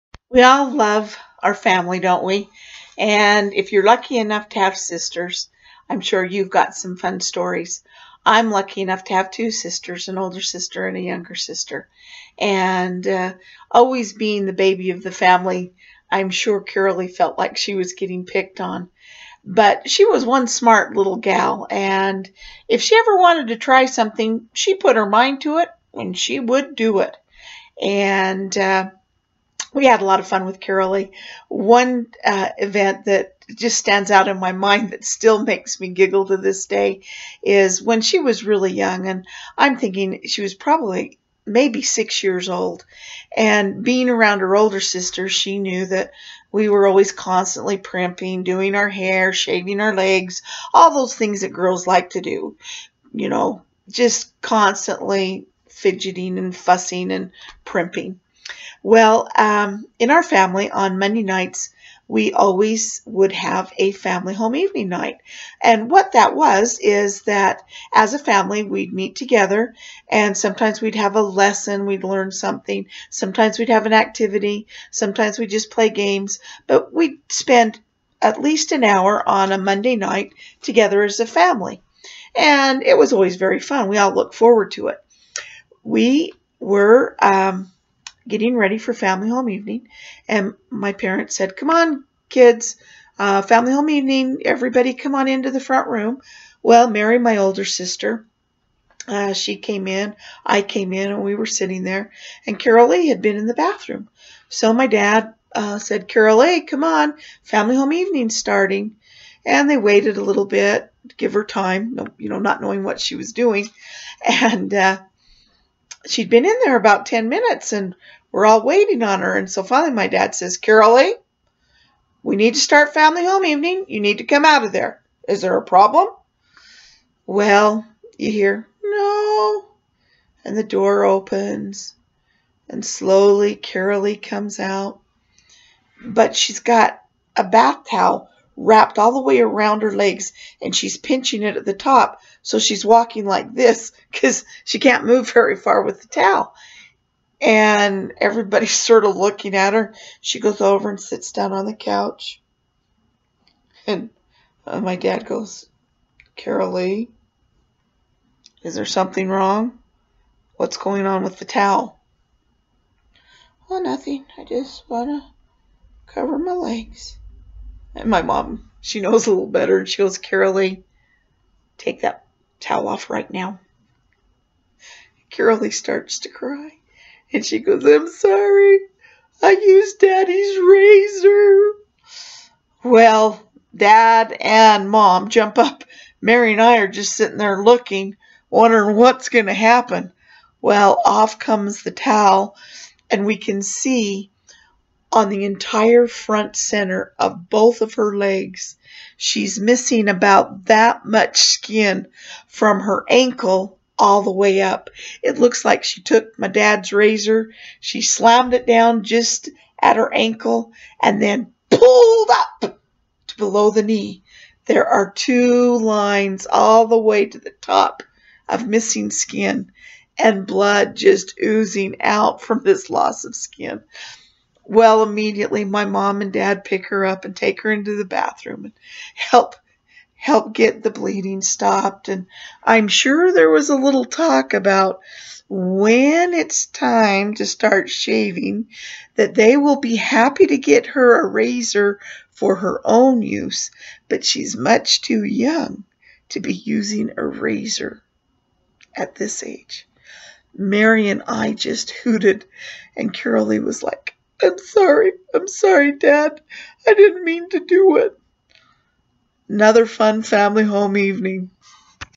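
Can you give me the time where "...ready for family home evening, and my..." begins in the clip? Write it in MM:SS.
01:28.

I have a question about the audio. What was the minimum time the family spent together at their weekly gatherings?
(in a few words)
An hour.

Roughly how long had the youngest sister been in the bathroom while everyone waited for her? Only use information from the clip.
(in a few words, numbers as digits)
10 minutes.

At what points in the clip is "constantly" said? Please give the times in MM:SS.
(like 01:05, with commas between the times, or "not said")
00:47, 00:54.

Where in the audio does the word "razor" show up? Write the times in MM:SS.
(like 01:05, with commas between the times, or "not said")
03:00, 03:26, 04:01, 04:07.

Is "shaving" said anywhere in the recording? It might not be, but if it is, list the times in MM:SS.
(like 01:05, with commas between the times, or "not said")
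00:49, 03:57.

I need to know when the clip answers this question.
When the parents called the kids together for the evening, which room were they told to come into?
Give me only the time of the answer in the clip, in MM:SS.
01:35.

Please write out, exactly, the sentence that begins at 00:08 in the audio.
I'm lucky enough to have two sisters, an older sister and a younger sister.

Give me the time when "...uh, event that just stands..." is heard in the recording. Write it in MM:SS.
00:32.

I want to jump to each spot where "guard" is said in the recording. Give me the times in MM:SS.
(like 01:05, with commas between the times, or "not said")
not said.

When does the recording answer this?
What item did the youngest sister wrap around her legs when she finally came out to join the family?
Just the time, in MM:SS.
02:17.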